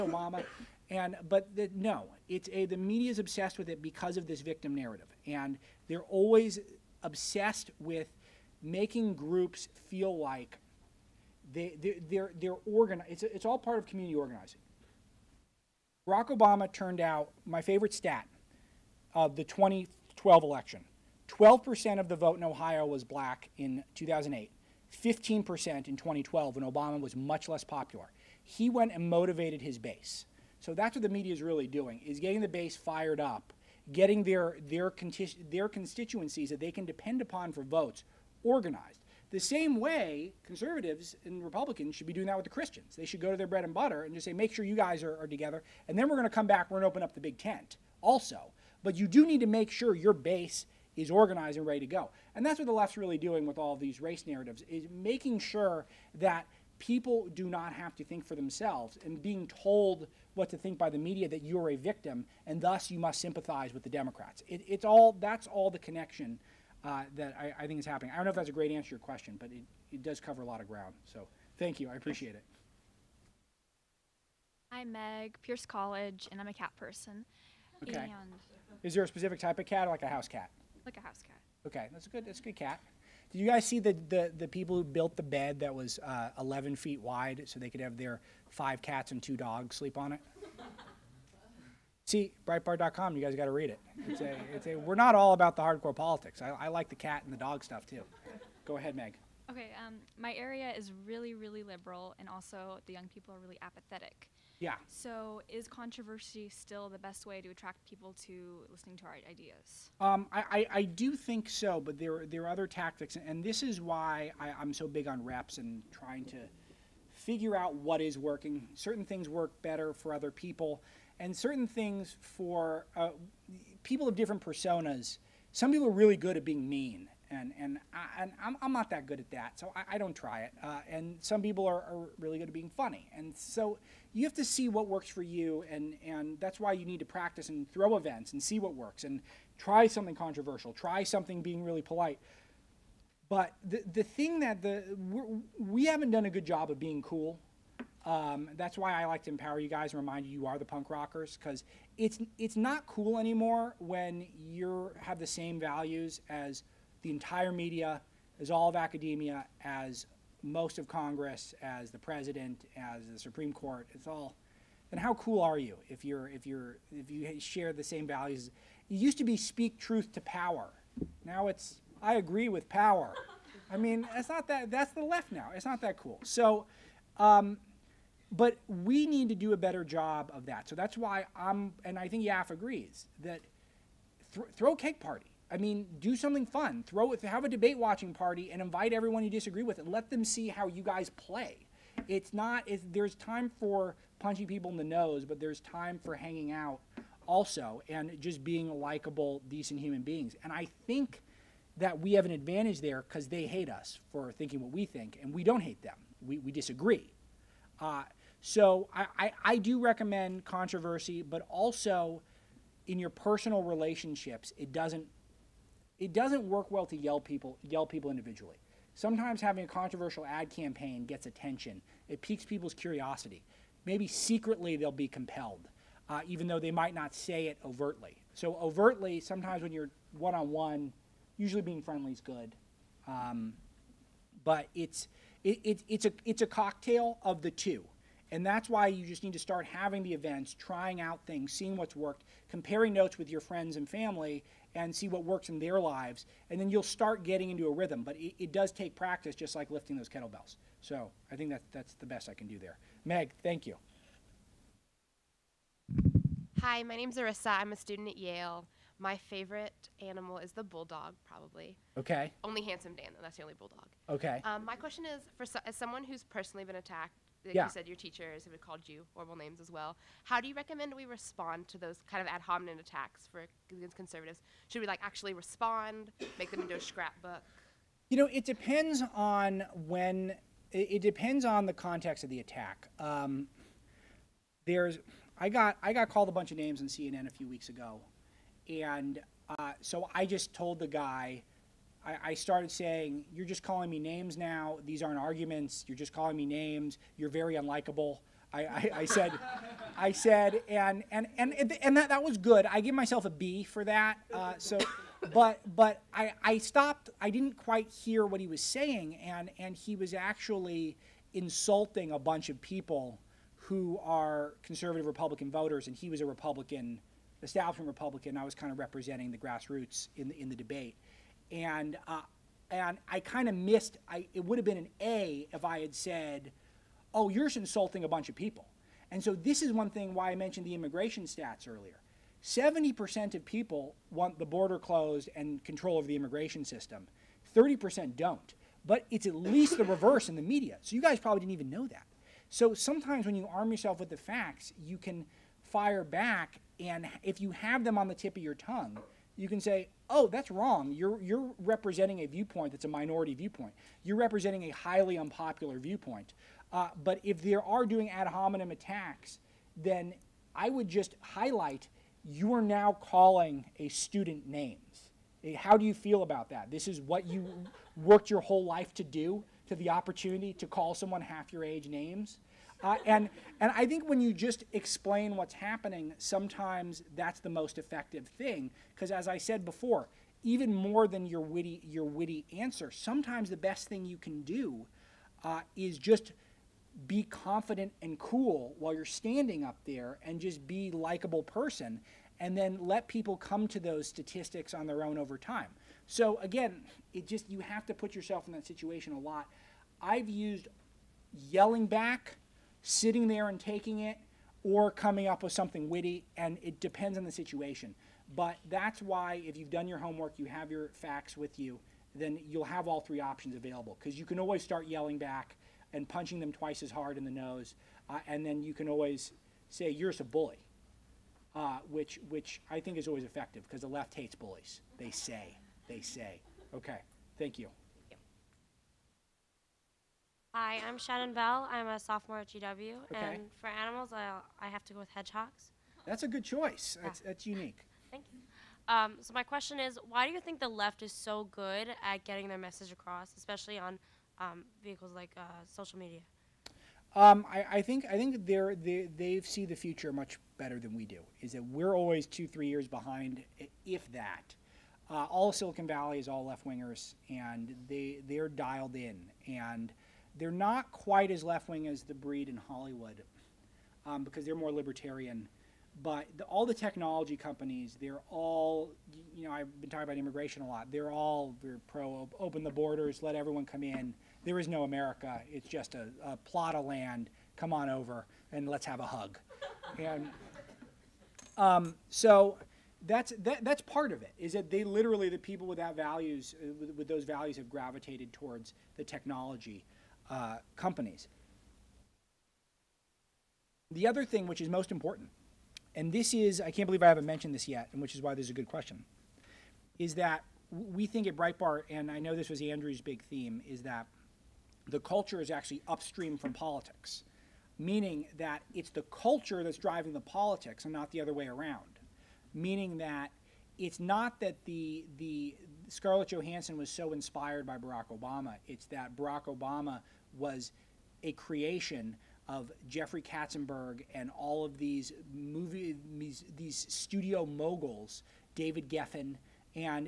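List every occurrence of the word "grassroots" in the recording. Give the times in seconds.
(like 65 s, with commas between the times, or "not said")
319 s.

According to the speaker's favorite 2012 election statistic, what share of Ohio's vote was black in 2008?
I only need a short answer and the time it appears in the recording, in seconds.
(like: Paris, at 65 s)
12%, at 21 s.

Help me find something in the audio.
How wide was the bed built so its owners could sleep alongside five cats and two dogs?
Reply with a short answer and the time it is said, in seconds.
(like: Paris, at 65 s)
11 feet, at 86 s.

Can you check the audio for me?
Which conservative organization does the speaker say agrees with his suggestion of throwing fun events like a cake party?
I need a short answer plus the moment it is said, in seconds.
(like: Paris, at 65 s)
YAF, at 182 s.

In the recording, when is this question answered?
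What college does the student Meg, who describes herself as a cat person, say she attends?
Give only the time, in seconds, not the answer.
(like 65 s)
75 s.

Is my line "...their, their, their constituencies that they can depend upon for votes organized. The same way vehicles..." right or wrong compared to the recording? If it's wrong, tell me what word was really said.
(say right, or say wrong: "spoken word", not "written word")
wrong: "conservatives", not "vehicles".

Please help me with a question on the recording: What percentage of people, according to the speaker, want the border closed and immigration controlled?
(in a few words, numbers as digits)
70%.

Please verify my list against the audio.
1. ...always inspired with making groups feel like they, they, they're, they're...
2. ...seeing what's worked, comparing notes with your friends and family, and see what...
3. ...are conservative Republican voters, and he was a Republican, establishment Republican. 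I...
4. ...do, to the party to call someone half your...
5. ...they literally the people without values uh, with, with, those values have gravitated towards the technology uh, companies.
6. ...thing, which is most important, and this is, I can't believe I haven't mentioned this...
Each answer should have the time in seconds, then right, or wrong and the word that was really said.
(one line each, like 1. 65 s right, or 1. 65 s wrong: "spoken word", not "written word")
1. 6 s wrong: "obsessed", not "inspired"
2. 241 s right
3. 314 s right
4. 369 s wrong: "opportunity", not "party"
5. 484 s right
6. 494 s right.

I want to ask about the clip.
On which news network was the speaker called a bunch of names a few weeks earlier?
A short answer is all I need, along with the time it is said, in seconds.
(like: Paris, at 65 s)
CNN, at 286 s.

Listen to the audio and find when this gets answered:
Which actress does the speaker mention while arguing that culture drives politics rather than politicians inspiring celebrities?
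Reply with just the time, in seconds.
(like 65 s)
515 s.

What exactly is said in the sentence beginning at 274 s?
Should we like actually respond, make them into a scrapbook?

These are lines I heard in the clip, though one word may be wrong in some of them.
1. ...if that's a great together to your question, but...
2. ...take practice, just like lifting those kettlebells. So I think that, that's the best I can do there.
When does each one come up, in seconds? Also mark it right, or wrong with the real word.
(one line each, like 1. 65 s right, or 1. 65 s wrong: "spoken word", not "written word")
1. 68 s wrong: "answer", not "together"
2. 248 s right.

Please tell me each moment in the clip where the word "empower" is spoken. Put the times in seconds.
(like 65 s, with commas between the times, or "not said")
149 s.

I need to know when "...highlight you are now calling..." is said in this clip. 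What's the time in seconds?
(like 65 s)
361 s.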